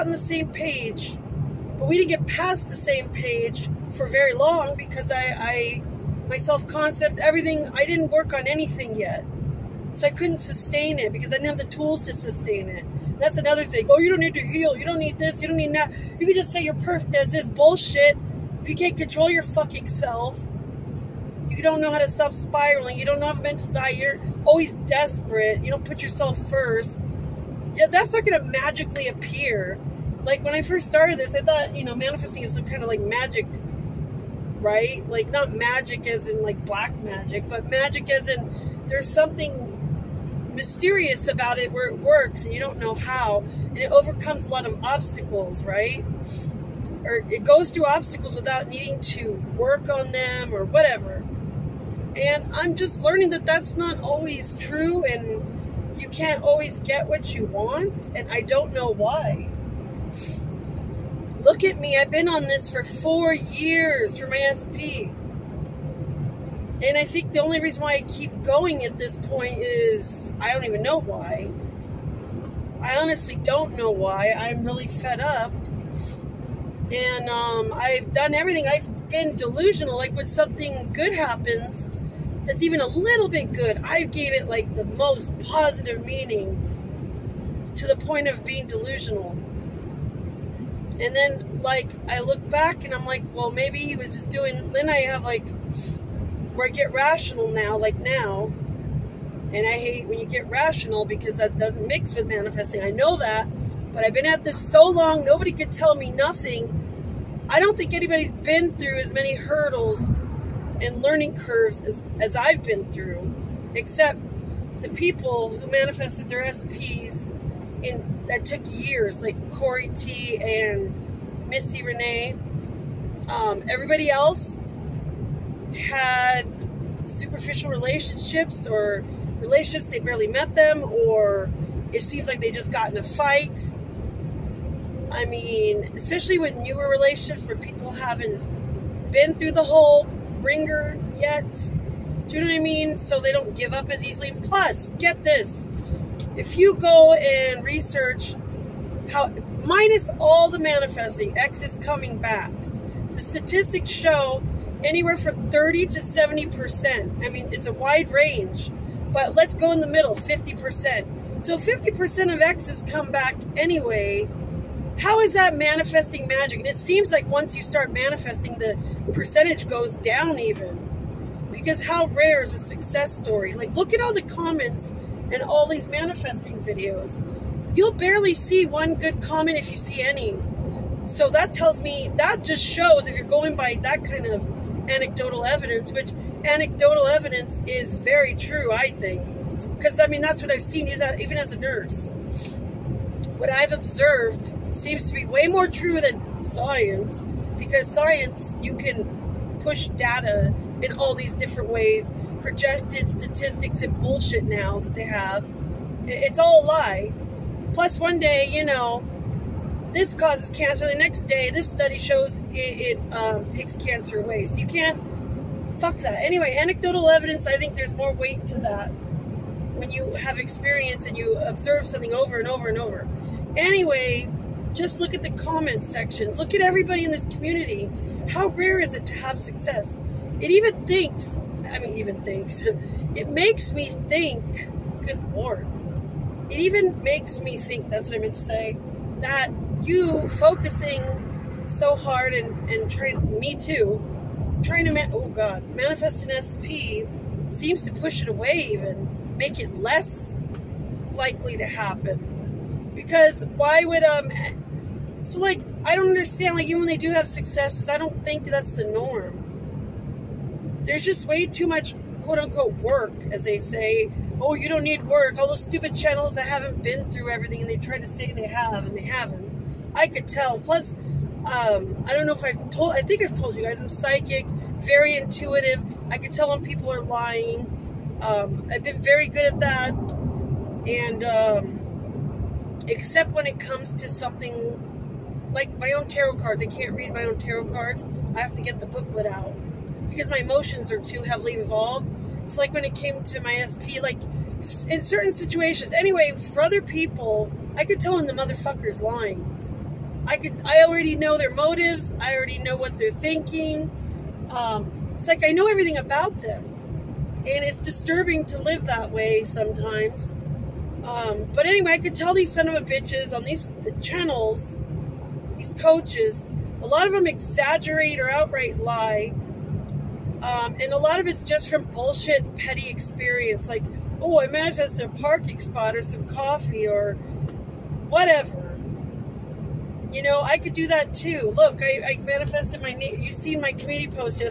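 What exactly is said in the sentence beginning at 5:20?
Um, and a lot of it's just from bullshit, petty experience.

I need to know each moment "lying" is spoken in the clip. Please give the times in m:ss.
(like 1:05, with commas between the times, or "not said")
4:37, 4:59.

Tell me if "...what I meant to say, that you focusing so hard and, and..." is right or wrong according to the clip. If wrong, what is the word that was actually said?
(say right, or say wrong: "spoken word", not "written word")
right.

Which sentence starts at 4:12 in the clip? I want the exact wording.
Because why would, um, so like, I don't understand, like even when they do have successes, I don't think that's the norm.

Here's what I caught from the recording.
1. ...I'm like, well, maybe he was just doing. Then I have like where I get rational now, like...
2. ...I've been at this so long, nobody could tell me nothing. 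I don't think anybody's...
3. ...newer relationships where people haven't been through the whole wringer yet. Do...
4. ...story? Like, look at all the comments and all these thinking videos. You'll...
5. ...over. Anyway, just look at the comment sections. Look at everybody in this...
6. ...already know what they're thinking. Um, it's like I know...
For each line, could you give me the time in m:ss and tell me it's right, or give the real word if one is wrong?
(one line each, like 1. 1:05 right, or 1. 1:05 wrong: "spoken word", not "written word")
1. 1:32 right
2. 1:44 right
3. 2:16 right
4. 2:53 wrong: "manifesting", not "thinking"
5. 3:42 right
6. 5:02 right.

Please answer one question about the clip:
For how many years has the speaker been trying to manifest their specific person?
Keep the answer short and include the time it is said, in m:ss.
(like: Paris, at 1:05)
4, at 1:02.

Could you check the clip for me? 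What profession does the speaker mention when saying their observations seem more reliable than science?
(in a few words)
Nurse.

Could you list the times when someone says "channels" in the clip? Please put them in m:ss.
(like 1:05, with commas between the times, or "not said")
4:25, 5:14.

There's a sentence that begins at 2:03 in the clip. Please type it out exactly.
Um, everybody else, had superficial relationships or relationships they barely met them or it seems like they just got in a fight.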